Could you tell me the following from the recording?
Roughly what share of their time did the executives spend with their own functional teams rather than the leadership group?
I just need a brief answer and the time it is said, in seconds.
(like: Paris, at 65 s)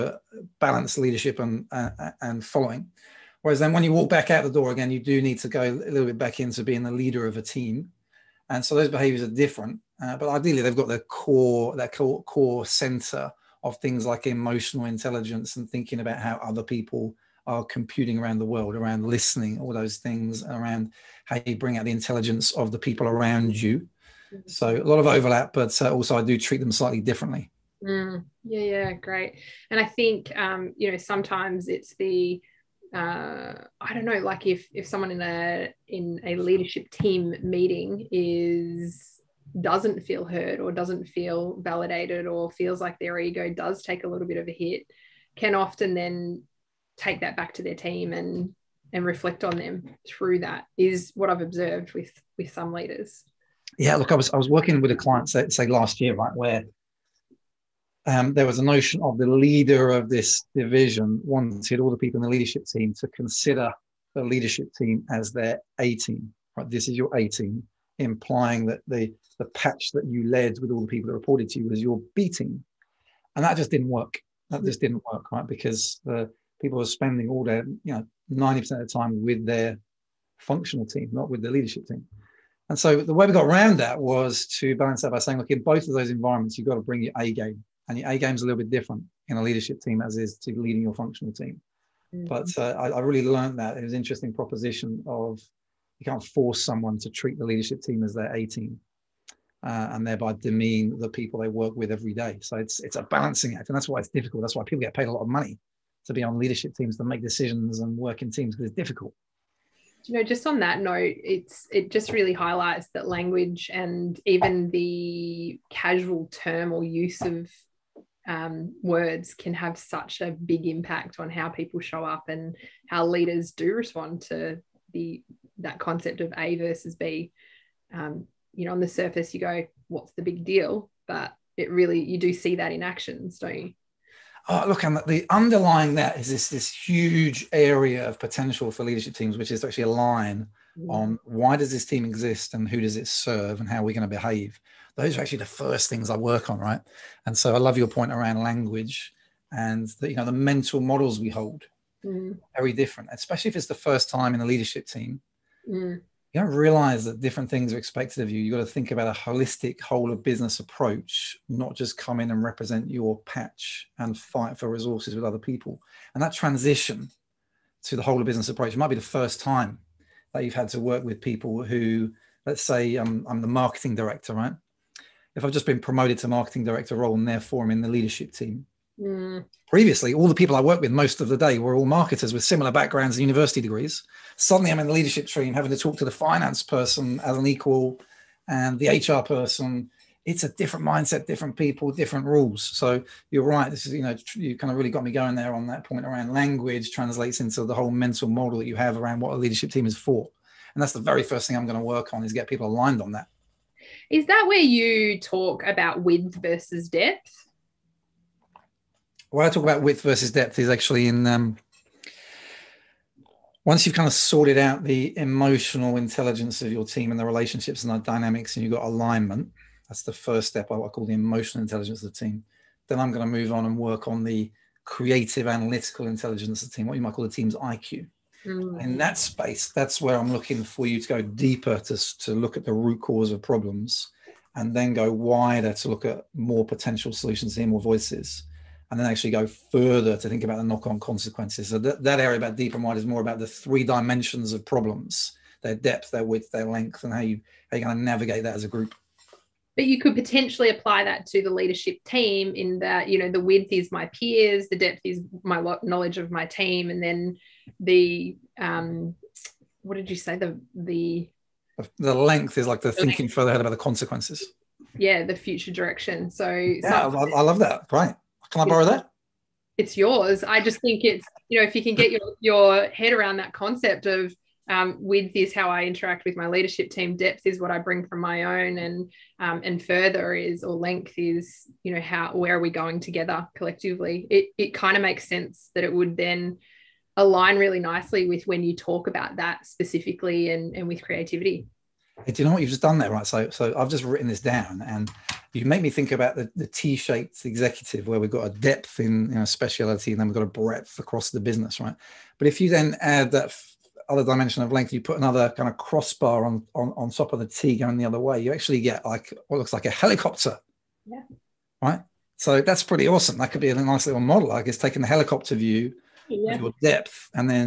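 90 percent, at 78 s.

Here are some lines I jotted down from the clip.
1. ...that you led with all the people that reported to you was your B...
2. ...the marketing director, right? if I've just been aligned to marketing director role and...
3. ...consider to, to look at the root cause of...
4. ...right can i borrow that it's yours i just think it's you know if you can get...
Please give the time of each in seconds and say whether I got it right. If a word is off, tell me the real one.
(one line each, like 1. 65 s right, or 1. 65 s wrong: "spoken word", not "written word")
1. 69 s right
2. 173 s wrong: "promoted", not "aligned"
3. 231 s wrong: "deeper", not "consider"
4. 267 s right.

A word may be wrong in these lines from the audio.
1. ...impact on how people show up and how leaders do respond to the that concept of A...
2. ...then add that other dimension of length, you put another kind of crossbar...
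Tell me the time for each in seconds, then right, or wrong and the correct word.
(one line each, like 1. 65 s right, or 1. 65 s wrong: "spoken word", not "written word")
1. 120 s right
2. 302 s right.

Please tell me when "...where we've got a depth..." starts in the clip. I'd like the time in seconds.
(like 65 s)
298 s.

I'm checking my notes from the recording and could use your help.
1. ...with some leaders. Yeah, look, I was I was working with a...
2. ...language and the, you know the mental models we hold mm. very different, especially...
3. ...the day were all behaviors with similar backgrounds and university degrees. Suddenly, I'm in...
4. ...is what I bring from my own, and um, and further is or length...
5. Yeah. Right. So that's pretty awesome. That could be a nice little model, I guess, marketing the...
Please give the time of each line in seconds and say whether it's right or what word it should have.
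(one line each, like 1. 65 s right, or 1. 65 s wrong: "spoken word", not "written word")
1. 52 s right
2. 148 s right
3. 181 s wrong: "marketers", not "behaviors"
4. 277 s right
5. 311 s wrong: "taking", not "marketing".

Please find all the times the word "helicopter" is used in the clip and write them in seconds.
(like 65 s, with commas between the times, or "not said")
309 s, 315 s.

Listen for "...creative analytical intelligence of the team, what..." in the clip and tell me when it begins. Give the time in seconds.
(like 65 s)
224 s.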